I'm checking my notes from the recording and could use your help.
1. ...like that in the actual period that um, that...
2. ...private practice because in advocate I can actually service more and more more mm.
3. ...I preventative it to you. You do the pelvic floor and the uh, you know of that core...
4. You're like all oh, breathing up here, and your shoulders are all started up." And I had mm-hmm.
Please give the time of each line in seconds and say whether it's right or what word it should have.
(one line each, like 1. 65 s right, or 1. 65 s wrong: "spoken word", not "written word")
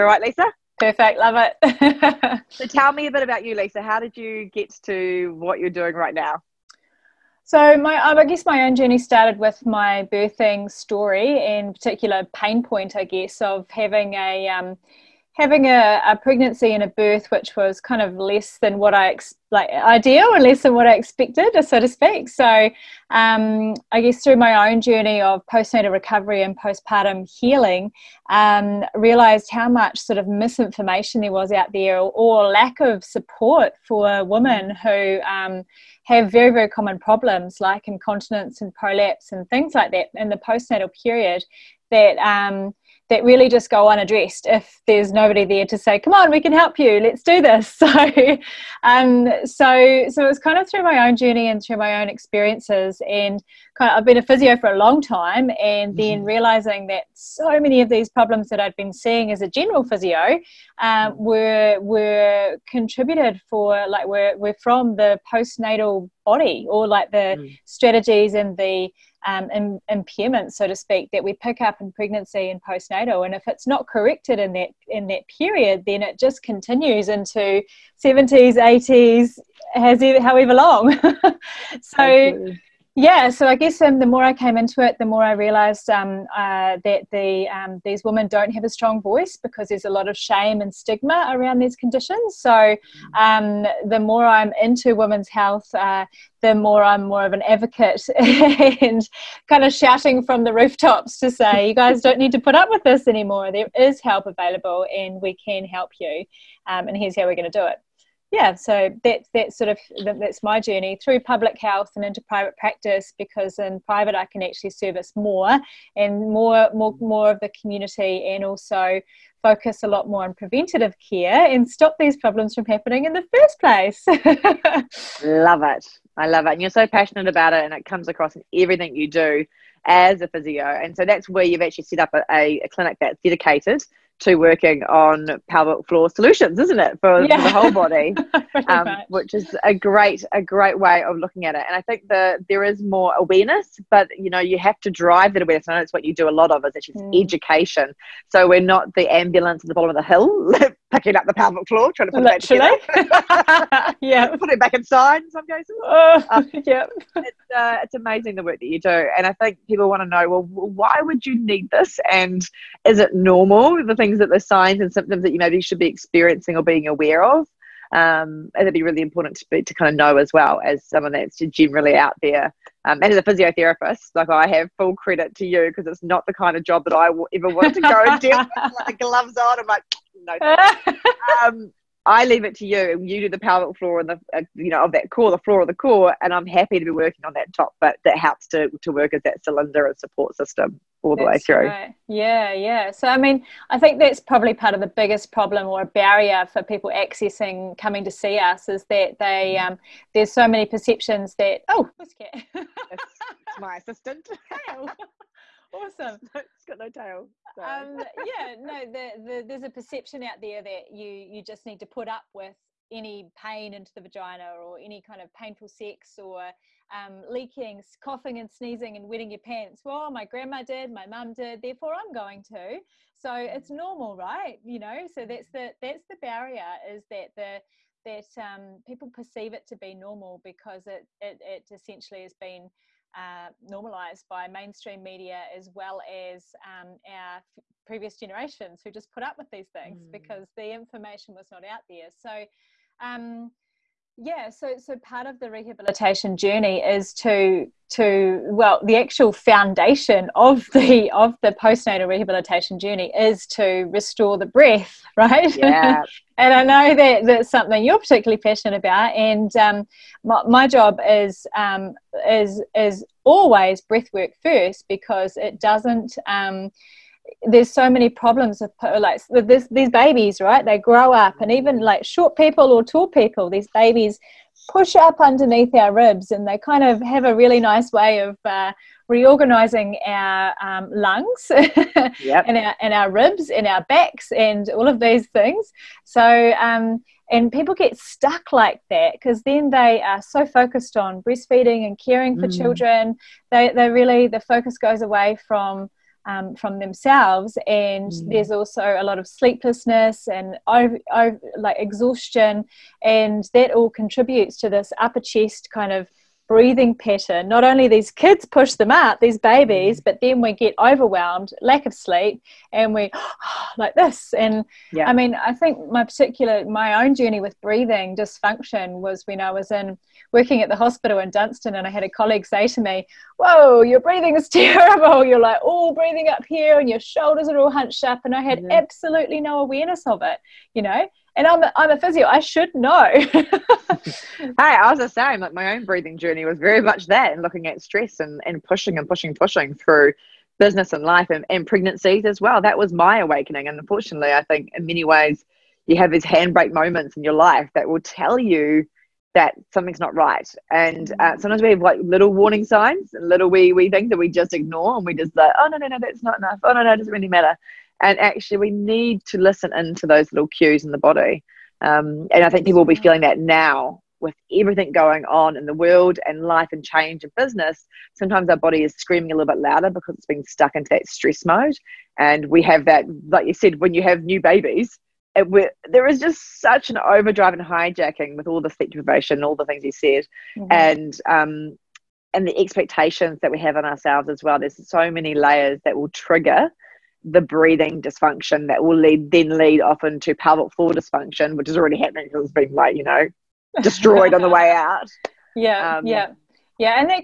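1. 39 s wrong: "postnatal", not "actual"
2. 112 s wrong: "private", not "advocate"
3. 182 s wrong: "leave", not "preventative"
4. 325 s wrong: "hunched", not "started".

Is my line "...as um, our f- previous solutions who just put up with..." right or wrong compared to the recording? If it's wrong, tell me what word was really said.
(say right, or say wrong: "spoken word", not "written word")
wrong: "generations", not "solutions".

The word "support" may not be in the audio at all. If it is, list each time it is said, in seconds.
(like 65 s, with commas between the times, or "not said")
33 s, 189 s.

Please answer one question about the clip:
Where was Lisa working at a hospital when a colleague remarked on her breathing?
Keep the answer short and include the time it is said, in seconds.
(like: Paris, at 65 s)
Dunstan, at 321 s.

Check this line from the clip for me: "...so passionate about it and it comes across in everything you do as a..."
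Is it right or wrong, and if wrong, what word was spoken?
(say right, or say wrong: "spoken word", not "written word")
right.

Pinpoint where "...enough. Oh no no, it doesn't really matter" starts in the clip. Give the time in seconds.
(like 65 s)
356 s.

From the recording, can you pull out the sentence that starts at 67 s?
strategies and the um, Im- impairments, so to speak, that we pick up in pregnancy and postnatal.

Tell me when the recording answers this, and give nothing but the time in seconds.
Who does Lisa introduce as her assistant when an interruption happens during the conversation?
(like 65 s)
201 s.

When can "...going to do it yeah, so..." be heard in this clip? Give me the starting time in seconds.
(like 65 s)
107 s.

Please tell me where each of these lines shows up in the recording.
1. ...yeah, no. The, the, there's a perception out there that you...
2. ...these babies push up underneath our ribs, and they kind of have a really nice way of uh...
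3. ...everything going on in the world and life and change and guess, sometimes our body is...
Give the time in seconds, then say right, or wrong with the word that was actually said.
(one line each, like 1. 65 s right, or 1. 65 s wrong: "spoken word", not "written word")
1. 208 s right
2. 273 s right
3. 364 s wrong: "business", not "guess".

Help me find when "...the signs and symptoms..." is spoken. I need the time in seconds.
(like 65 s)
164 s.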